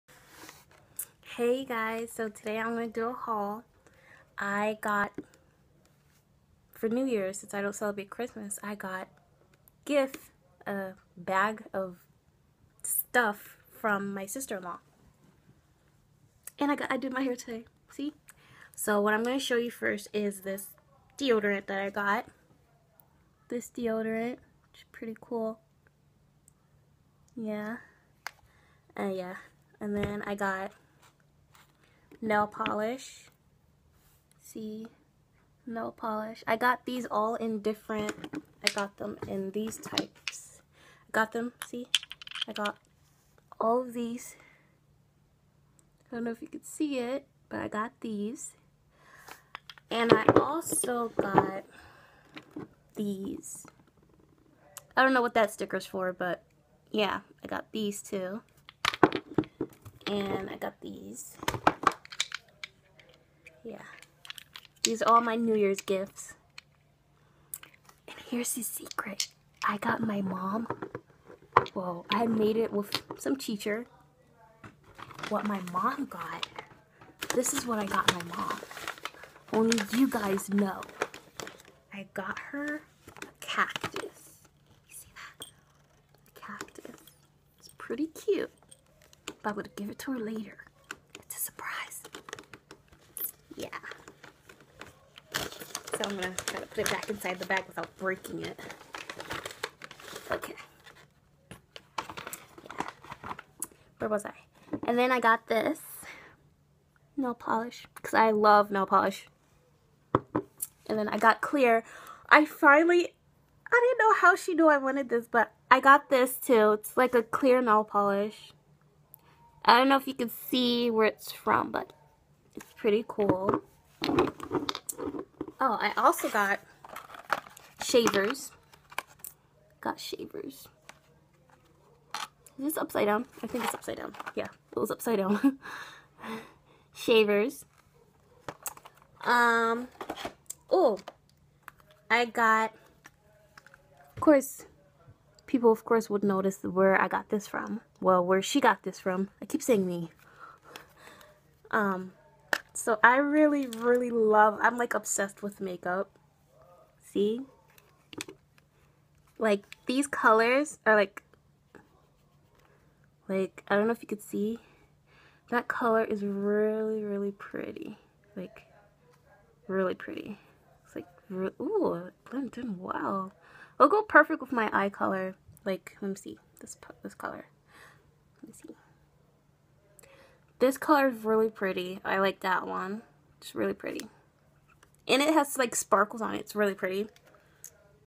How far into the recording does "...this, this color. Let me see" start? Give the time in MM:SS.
02:56.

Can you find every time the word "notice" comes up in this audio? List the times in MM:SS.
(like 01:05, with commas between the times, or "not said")
02:26.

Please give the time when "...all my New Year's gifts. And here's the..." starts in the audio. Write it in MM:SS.
01:05.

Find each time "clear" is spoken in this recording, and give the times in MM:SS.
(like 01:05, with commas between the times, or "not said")
01:51, 01:57.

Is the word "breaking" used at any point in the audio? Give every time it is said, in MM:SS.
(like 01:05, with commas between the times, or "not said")
01:37.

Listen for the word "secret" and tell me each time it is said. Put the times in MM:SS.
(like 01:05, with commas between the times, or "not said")
01:08.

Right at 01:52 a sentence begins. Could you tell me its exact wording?
I finally, I didn't know how she knew I wanted this, but I got this too.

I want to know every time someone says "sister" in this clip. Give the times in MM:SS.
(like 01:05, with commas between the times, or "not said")
00:14.